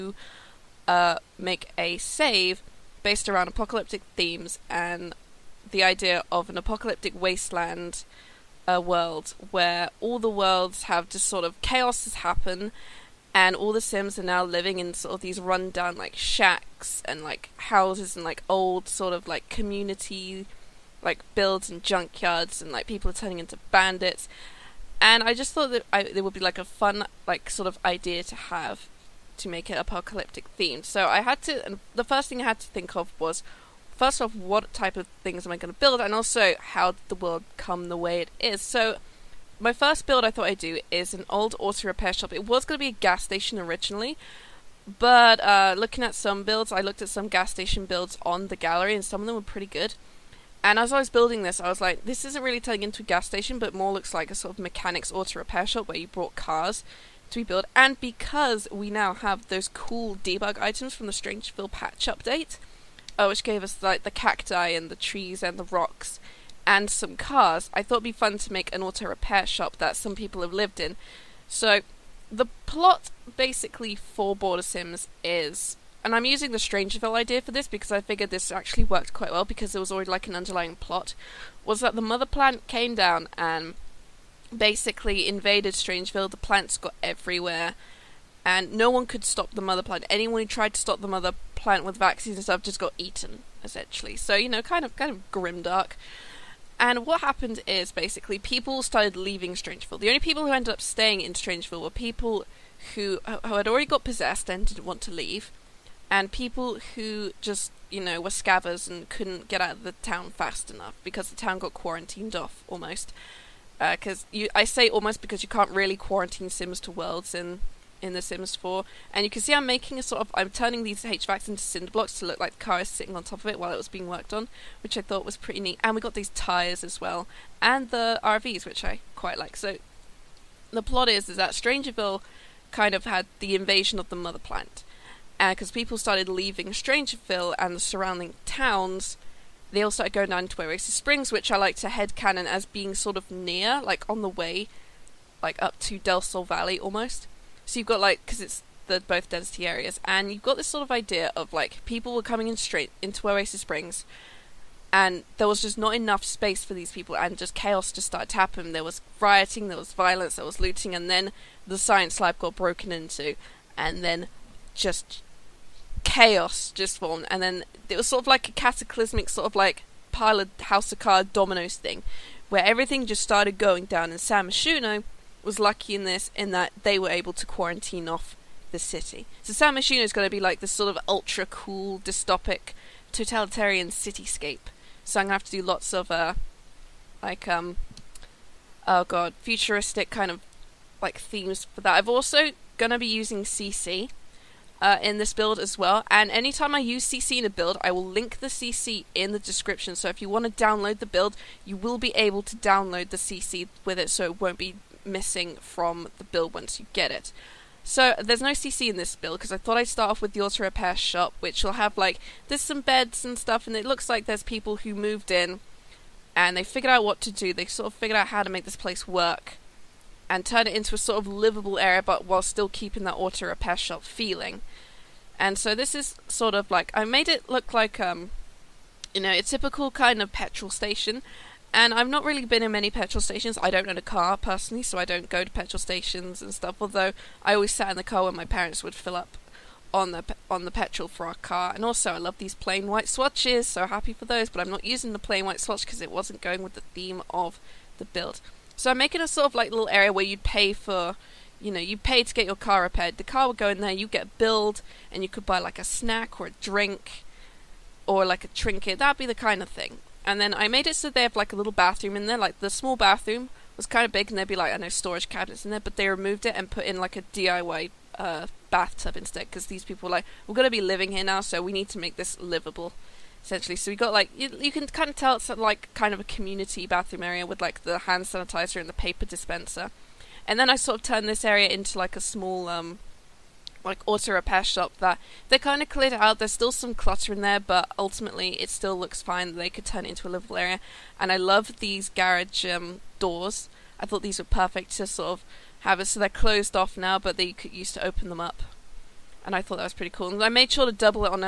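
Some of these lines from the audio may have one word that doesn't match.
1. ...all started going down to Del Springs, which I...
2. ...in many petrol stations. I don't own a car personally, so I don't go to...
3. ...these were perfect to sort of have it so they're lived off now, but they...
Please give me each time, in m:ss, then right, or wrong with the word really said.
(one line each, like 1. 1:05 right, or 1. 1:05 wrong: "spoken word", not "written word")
1. 2:19 wrong: "Oasis", not "Del"
2. 3:52 right
3. 4:54 wrong: "closed", not "lived".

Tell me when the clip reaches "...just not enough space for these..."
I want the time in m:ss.
2:35.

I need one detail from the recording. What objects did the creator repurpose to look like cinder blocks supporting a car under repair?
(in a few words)
HVACs.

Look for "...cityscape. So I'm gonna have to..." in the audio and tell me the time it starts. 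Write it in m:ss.
3:03.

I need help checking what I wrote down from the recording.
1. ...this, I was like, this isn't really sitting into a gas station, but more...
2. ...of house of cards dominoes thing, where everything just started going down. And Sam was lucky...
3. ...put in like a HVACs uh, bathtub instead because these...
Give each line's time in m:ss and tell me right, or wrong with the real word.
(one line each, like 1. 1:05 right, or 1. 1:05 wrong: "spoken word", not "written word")
1. 0:51 wrong: "turning", not "sitting"
2. 2:50 right
3. 4:26 wrong: "DIY", not "HVACs".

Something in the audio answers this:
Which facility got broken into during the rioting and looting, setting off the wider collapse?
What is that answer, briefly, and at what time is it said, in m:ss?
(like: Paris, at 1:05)
The science lab, at 2:41.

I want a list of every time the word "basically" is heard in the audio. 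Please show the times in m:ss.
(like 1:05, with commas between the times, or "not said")
1:13, 1:24, 1:37.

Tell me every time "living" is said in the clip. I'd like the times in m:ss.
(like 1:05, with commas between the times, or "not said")
0:14, 4:30.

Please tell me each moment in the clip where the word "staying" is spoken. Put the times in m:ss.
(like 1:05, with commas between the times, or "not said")
1:40.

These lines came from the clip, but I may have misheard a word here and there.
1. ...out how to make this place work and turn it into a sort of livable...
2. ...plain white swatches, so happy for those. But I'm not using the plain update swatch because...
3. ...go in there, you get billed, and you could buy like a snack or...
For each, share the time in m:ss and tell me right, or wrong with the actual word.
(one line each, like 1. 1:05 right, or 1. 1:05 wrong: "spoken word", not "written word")
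1. 3:38 right
2. 4:02 wrong: "white", not "update"
3. 4:13 right.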